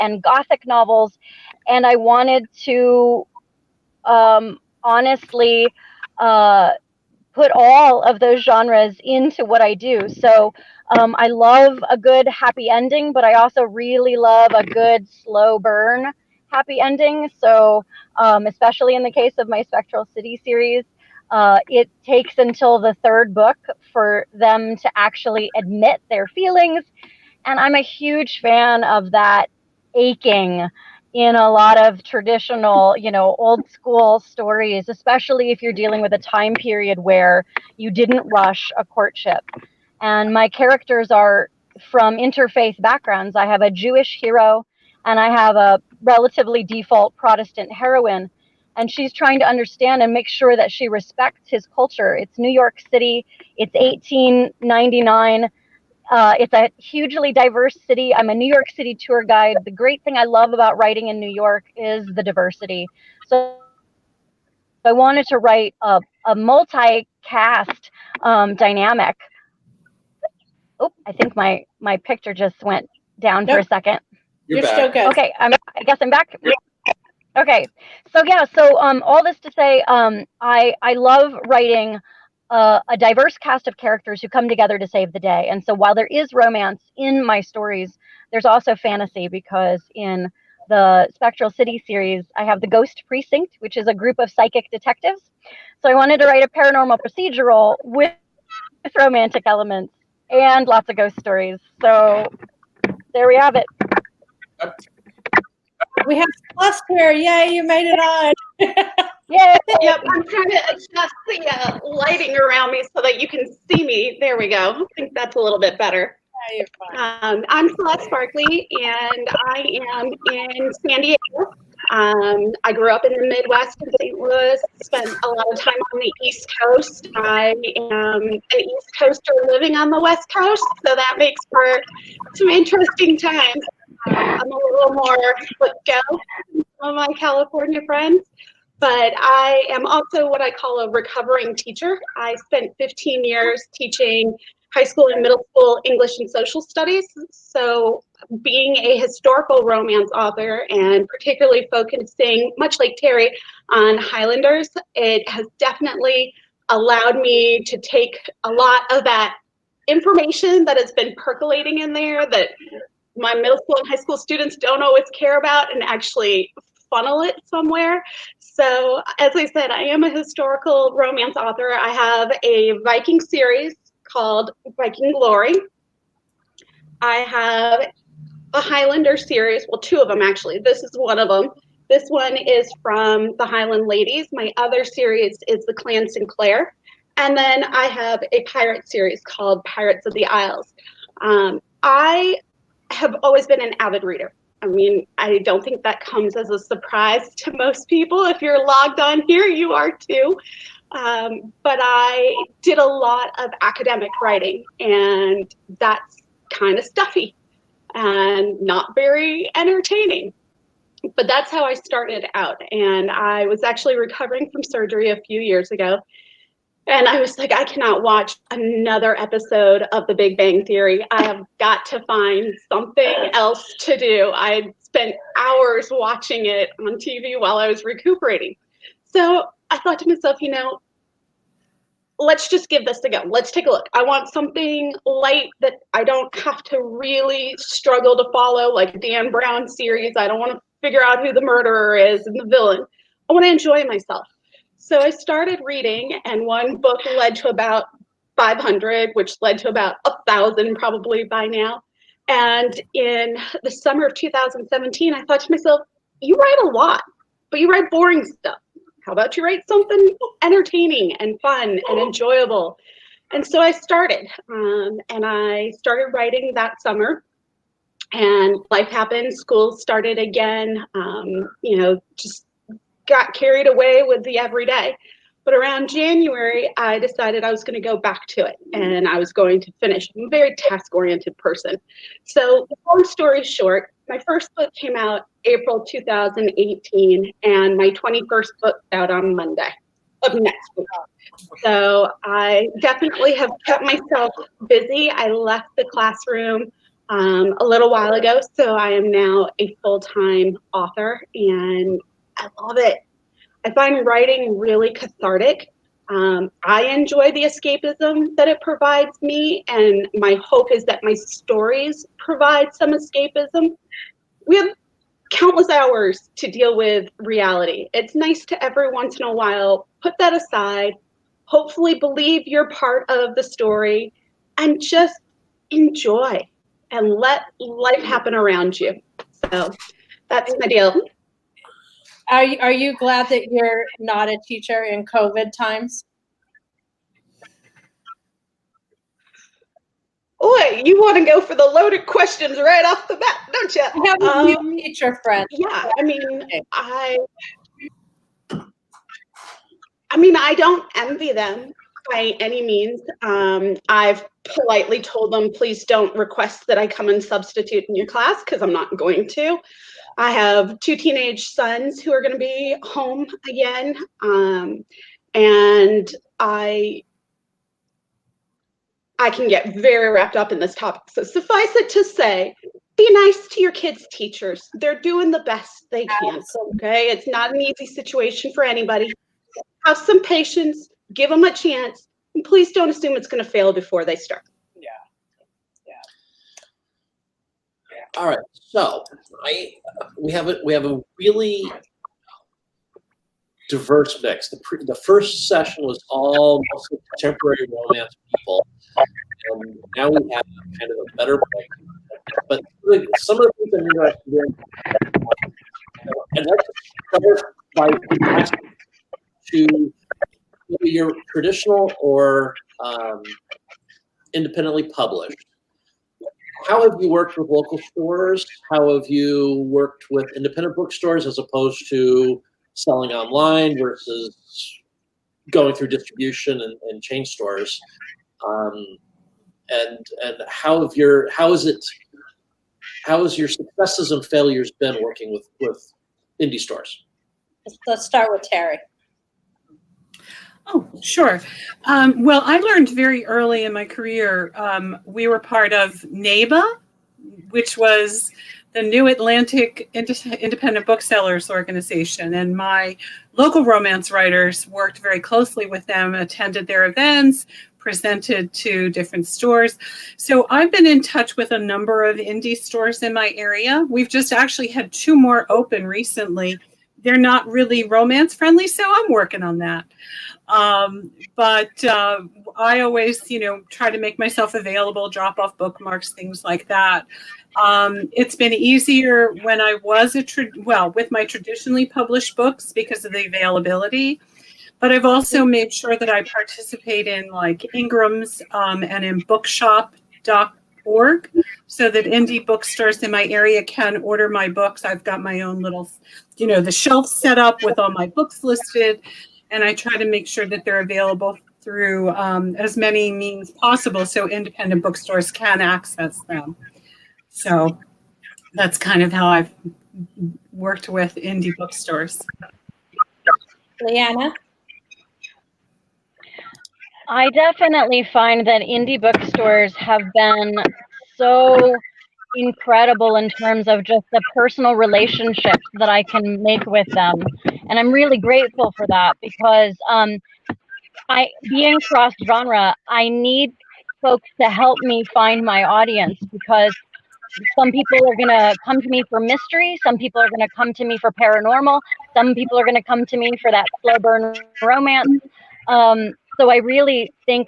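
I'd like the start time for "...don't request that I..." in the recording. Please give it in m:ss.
5:55.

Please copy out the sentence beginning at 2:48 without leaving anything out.
So, as I said, I am a historical romance author.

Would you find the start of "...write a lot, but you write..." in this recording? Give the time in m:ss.
4:16.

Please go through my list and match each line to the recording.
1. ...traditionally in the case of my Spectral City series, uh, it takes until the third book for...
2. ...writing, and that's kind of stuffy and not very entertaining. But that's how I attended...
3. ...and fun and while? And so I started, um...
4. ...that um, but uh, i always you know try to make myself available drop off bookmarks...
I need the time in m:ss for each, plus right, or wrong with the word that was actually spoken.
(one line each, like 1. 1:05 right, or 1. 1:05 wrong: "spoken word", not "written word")
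1. 0:18 wrong: "especially", not "traditionally"
2. 3:24 wrong: "started", not "attended"
3. 4:21 wrong: "enjoyable", not "while"
4. 7:49 right.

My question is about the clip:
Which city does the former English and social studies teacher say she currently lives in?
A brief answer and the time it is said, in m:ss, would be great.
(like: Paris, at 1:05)
San Diego, at 2:00.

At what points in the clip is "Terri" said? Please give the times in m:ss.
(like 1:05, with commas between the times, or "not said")
2:33, 7:18.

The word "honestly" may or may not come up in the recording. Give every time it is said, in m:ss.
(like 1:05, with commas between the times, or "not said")
0:04.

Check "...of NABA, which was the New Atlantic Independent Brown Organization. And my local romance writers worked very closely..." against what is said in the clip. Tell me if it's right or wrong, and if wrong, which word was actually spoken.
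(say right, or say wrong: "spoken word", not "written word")
wrong: "Booksellers", not "Brown".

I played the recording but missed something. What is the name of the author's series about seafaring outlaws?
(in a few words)
Pirates of the Isles.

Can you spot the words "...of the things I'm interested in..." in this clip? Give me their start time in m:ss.
6:43.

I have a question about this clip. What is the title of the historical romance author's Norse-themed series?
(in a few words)
Viking Glory.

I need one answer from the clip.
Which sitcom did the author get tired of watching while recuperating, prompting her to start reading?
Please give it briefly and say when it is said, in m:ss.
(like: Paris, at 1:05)
The Big Bang Theory, at 3:40.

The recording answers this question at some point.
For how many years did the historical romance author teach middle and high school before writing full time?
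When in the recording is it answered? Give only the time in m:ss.
2:22.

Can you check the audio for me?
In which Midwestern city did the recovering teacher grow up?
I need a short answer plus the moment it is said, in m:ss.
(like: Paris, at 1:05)
St. Louis, at 2:04.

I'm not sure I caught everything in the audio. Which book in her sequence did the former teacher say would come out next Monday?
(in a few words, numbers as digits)
21st.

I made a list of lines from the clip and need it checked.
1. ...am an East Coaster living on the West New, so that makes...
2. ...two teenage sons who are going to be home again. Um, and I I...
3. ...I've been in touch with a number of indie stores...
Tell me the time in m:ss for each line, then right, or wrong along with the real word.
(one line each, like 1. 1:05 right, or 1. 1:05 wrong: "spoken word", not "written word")
1. 2:07 wrong: "Coast", not "New"
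2. 6:00 right
3. 7:40 right.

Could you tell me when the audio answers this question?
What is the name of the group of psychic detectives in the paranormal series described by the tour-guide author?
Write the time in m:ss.
1:32.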